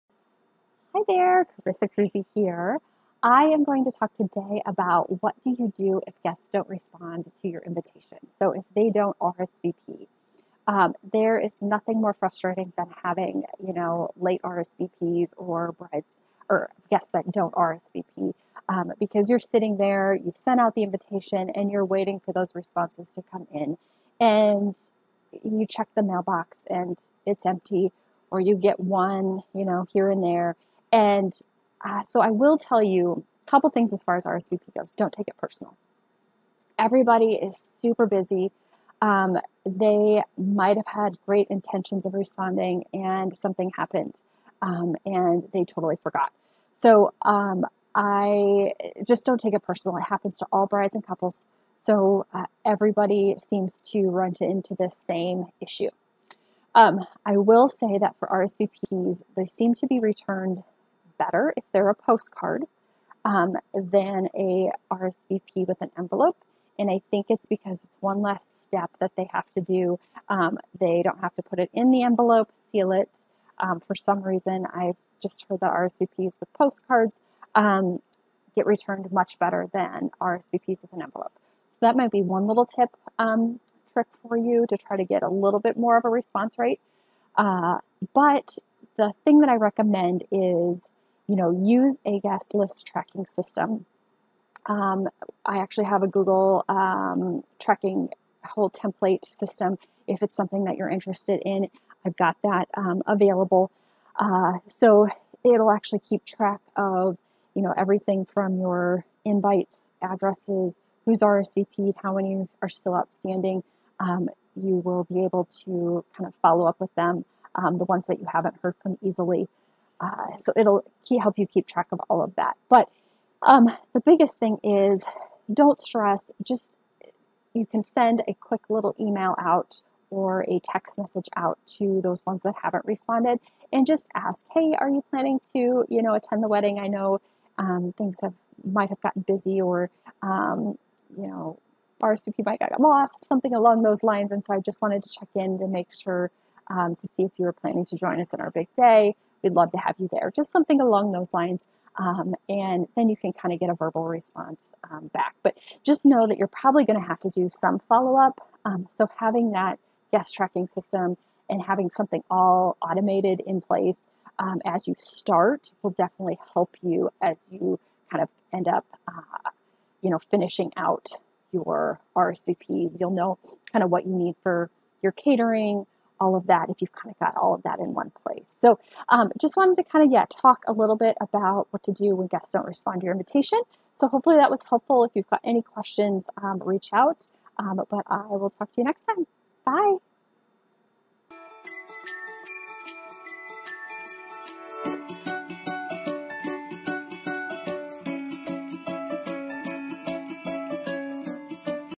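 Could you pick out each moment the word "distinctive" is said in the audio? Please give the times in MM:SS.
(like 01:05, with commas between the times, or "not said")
not said.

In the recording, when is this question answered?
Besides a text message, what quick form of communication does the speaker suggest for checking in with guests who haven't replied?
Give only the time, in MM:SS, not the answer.
02:08.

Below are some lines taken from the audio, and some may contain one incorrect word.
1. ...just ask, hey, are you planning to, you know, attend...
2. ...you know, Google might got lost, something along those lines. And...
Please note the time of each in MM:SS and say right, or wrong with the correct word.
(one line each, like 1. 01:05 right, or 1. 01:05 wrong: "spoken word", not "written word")
1. 02:13 right
2. 02:21 wrong: "RSVP", not "Google".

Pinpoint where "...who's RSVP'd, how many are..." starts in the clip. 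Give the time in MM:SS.
01:51.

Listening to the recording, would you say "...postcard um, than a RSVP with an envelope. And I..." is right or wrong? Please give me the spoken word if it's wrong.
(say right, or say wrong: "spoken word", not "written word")
right.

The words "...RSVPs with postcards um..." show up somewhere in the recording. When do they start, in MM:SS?
01:15.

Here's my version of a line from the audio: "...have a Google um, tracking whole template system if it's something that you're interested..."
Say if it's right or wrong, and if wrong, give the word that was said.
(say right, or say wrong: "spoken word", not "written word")
right.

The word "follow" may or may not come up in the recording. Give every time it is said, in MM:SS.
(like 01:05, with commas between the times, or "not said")
01:56, 02:37.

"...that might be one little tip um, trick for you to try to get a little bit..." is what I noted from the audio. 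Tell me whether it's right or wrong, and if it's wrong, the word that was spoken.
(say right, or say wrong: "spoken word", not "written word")
right.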